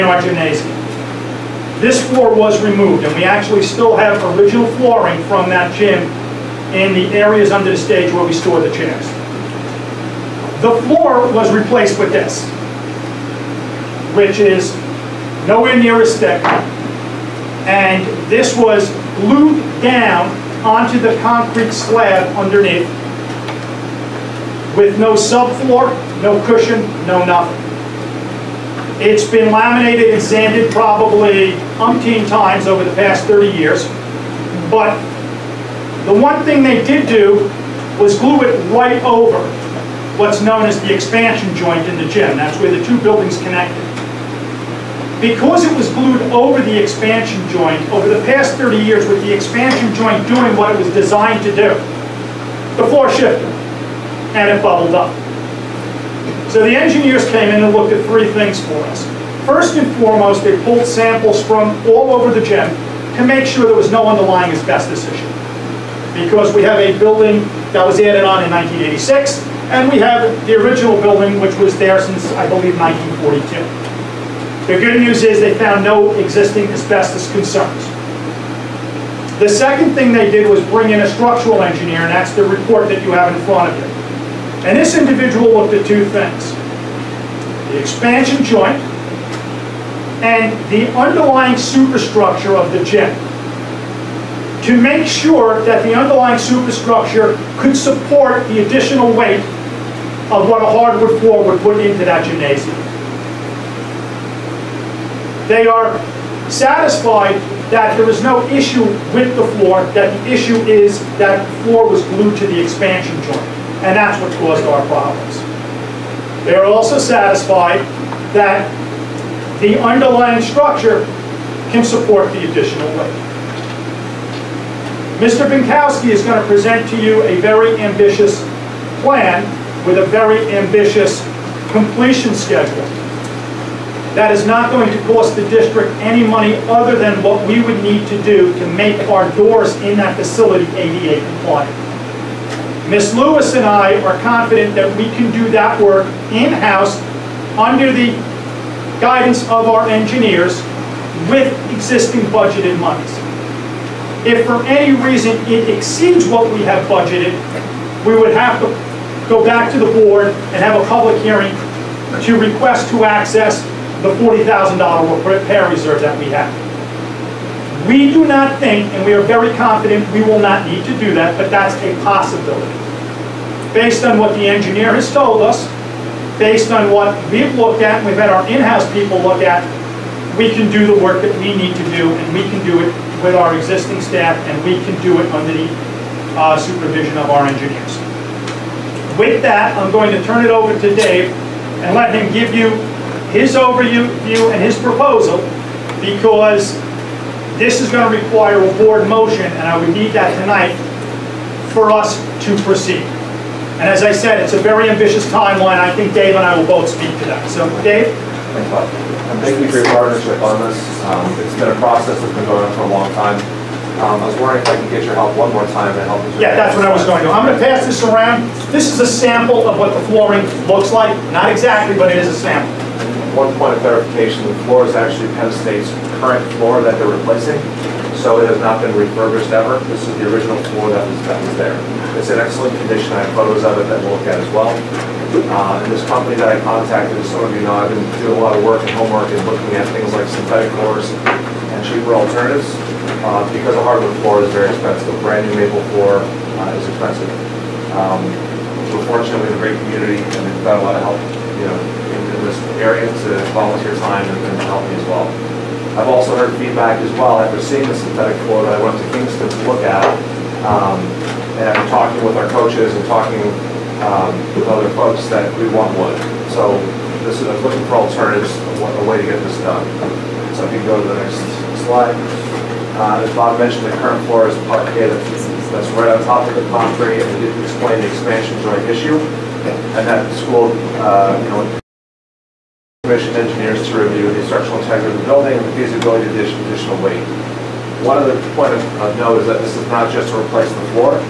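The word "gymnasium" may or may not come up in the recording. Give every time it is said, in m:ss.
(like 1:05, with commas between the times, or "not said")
0:00, 1:42.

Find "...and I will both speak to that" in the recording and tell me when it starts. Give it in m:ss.
3:26.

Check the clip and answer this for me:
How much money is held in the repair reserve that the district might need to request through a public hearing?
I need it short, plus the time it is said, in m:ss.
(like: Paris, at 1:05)
$40,000, at 2:44.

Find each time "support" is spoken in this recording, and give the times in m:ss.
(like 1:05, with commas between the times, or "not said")
1:37, 2:01.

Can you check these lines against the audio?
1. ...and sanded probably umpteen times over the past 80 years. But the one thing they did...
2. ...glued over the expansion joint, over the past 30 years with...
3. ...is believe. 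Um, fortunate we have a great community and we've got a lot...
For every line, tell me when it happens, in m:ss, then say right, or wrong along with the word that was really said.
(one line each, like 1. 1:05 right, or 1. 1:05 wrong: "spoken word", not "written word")
1. 0:30 wrong: "30", not "80"
2. 0:45 right
3. 4:06 wrong: "expensive", not "believe".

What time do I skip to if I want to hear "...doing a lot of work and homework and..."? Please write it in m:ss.
3:58.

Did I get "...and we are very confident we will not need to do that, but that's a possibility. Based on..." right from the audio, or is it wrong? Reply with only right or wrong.
right.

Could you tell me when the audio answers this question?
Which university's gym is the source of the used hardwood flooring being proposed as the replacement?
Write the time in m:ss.
3:45.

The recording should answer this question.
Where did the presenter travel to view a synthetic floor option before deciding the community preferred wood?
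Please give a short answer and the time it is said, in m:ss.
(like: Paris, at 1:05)
Kingston, at 4:19.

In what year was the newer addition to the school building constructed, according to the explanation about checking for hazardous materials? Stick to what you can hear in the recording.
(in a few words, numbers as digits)
1986.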